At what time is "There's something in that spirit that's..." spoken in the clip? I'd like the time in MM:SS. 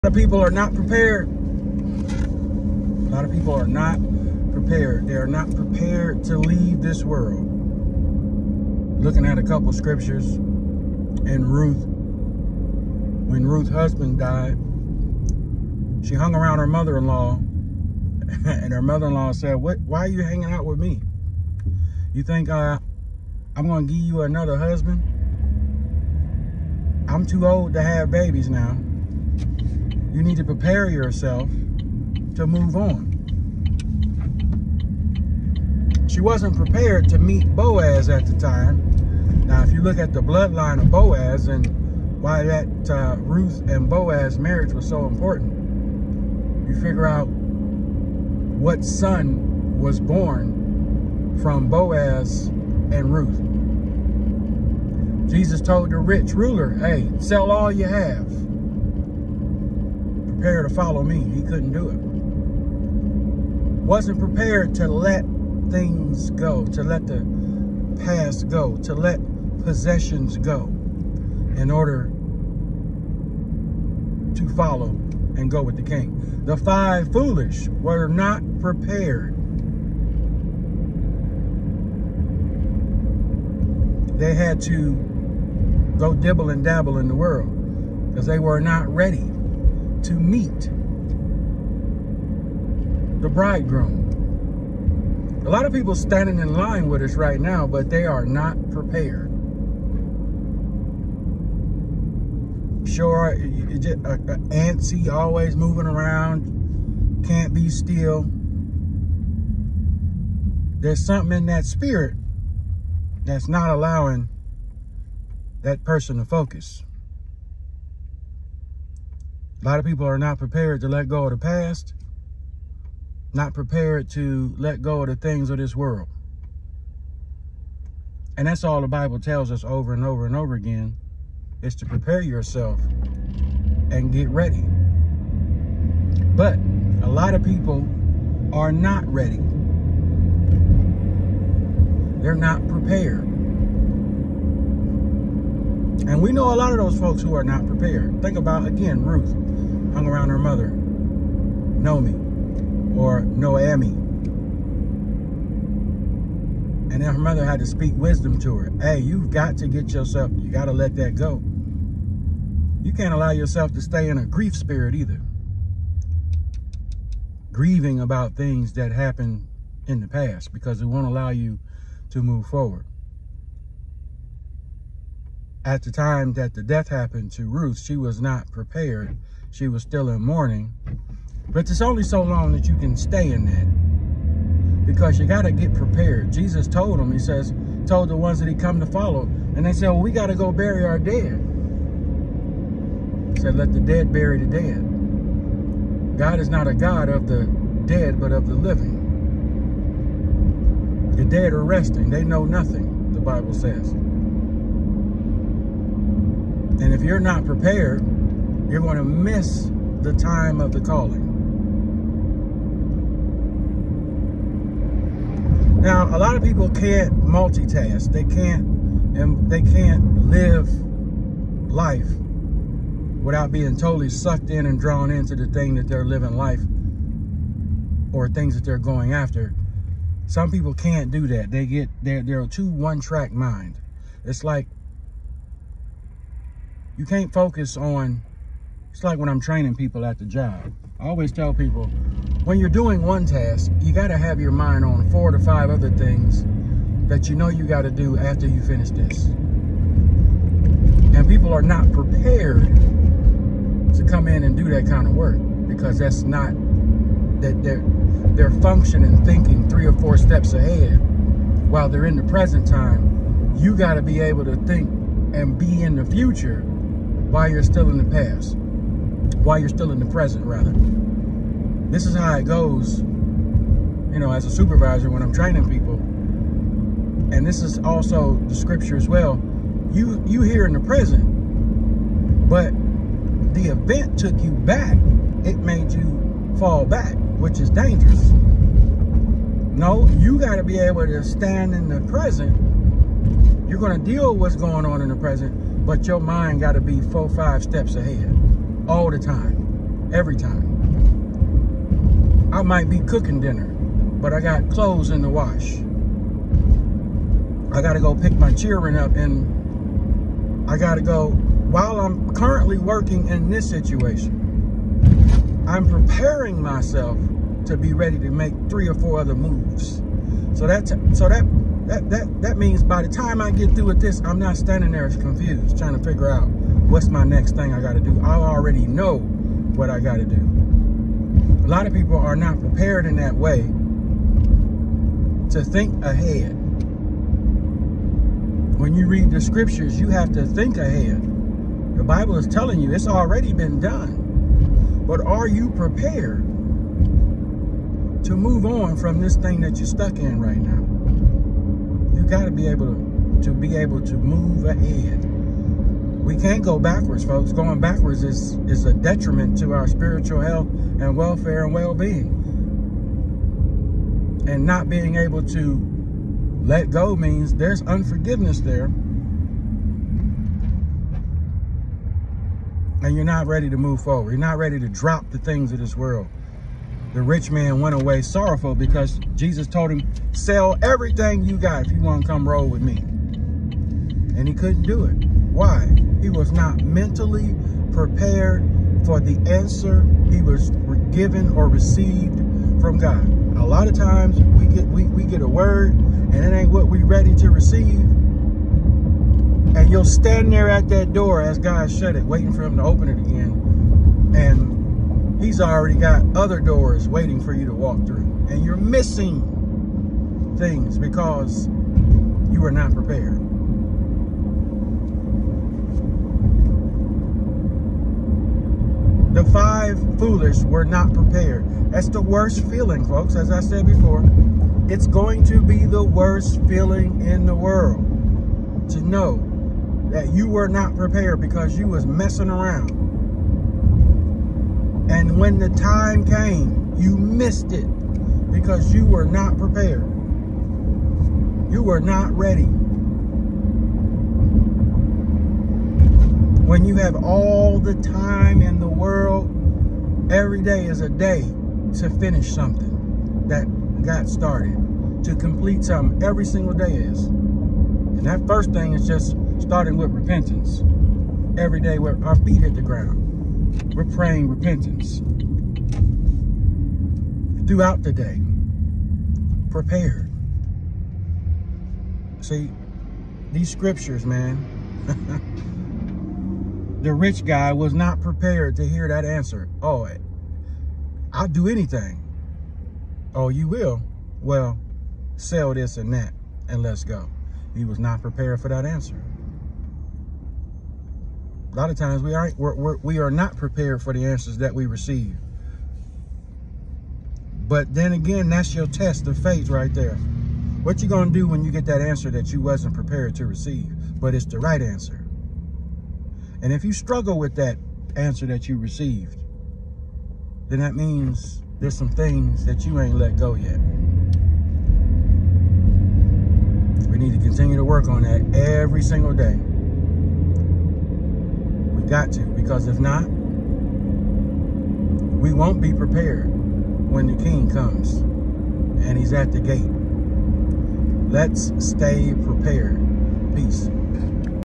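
01:50.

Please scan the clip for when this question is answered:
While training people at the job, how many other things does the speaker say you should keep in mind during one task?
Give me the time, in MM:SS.
04:05.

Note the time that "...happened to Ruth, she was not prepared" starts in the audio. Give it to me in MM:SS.
02:56.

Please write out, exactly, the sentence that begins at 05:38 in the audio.
When you read the scriptures, you have to think ahead.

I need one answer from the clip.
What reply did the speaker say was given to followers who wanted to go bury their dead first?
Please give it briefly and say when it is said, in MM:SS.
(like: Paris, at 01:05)
let the dead bury the dead, at 03:13.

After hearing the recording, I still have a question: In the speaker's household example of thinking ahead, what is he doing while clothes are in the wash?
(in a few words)
cooking dinner.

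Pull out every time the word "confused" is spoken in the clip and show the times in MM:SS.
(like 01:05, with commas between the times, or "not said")
05:25.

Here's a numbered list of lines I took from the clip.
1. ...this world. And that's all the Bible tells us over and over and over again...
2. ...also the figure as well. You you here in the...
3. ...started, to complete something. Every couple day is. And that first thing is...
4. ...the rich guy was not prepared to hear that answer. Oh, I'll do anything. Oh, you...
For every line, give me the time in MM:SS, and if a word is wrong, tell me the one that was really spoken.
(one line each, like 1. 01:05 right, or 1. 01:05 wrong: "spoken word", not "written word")
1. 02:05 right
2. 04:37 wrong: "scripture", not "figure"
3. 07:34 wrong: "single", not "couple"
4. 07:57 right.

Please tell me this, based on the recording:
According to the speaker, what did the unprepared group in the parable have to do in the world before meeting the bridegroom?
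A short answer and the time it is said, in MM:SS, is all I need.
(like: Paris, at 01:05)
dibble and dabble, at 01:26.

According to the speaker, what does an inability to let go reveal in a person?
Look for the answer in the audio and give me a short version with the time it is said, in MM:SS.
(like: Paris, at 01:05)
unforgiveness, at 06:07.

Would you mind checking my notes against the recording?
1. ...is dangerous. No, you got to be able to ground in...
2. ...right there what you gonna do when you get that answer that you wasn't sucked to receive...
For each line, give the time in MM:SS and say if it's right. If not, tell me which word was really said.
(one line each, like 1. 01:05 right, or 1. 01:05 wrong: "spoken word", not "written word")
1. 04:47 wrong: "stand", not "ground"
2. 08:19 wrong: "prepared", not "sucked".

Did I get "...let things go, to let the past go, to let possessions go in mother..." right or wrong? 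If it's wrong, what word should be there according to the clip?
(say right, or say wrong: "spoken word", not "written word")
wrong: "order", not "mother".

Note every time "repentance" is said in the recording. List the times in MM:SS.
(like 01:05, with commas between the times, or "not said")
07:40, 07:44.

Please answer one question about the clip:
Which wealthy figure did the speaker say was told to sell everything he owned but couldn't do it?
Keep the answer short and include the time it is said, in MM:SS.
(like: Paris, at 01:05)
rich ruler, at 00:55.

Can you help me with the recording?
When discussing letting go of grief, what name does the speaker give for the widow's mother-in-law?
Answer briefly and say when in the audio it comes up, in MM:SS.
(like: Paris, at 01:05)
Nomi, at 02:30.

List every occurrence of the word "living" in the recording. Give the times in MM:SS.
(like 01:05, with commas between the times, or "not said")
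03:18, 03:46.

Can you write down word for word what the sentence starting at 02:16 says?
But a lot of people are not ready.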